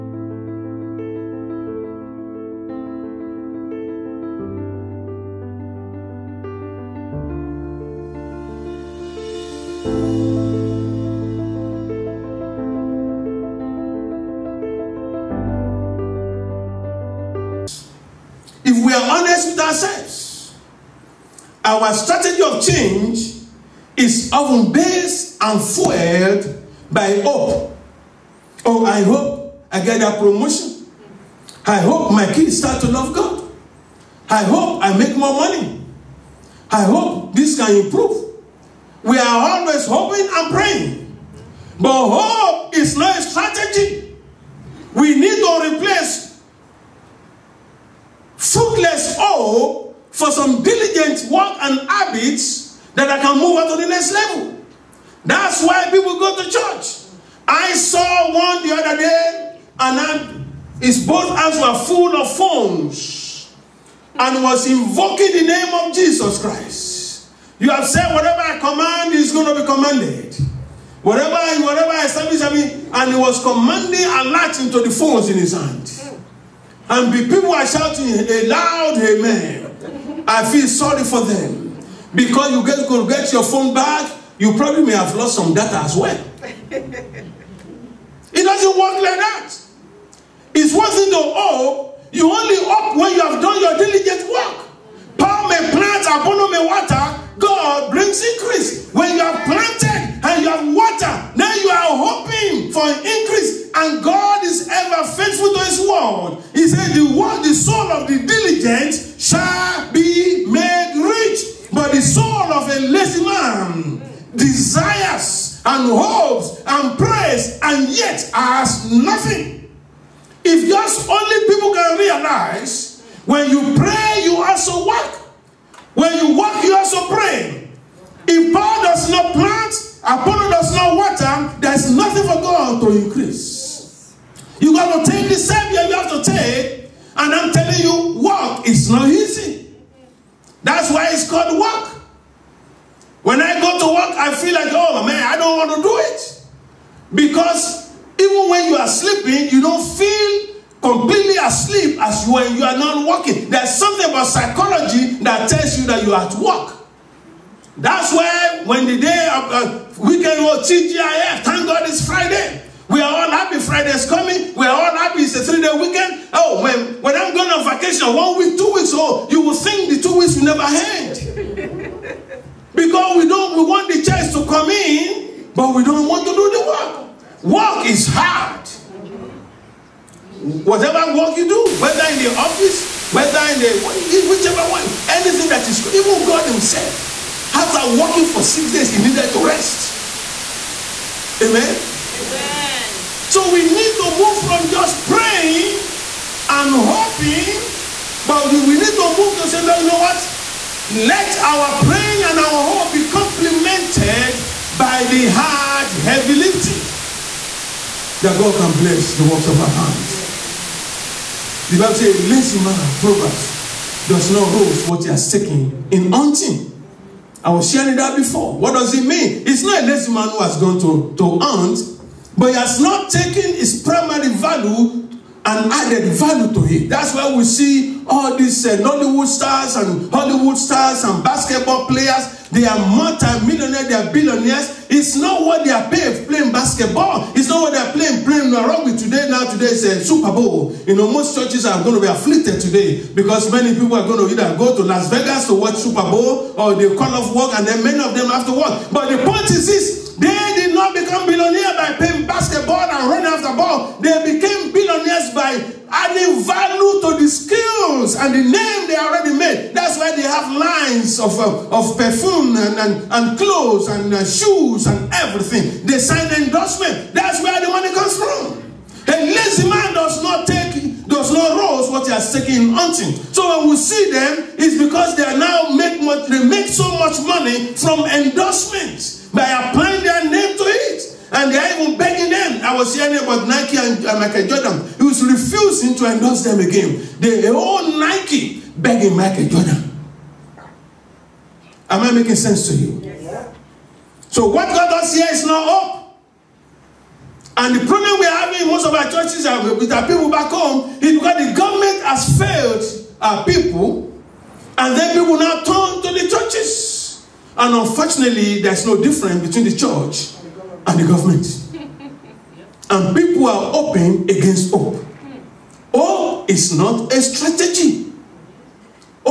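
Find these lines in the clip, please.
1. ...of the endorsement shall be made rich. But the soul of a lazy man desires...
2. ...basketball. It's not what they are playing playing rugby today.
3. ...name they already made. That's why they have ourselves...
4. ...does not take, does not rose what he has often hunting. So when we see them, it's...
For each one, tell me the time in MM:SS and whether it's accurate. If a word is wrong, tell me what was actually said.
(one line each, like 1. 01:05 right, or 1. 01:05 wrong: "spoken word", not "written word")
1. 01:47 wrong: "diligent", not "endorsement"
2. 03:56 right
3. 04:18 wrong: "lines", not "ourselves"
4. 04:29 wrong: "taken", not "often".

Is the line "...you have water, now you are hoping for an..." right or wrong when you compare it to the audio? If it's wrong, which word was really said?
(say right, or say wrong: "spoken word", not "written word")
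right.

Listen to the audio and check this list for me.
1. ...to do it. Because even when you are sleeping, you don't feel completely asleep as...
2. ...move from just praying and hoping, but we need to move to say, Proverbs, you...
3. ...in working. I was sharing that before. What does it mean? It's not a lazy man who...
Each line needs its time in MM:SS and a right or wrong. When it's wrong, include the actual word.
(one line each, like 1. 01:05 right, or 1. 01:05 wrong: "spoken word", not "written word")
1. 02:25 right
2. 03:14 wrong: "Lord", not "Proverbs"
3. 03:35 wrong: "hunting", not "working".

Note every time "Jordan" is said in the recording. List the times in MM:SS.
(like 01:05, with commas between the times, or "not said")
04:44, 04:49.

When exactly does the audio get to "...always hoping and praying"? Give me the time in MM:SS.
00:39.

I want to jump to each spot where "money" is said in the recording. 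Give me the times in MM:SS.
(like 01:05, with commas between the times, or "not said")
00:35, 04:27, 04:37.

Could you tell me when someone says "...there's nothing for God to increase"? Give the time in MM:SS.
02:11.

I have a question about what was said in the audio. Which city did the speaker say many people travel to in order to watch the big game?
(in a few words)
Las Vegas.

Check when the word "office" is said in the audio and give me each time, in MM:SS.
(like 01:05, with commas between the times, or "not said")
03:02.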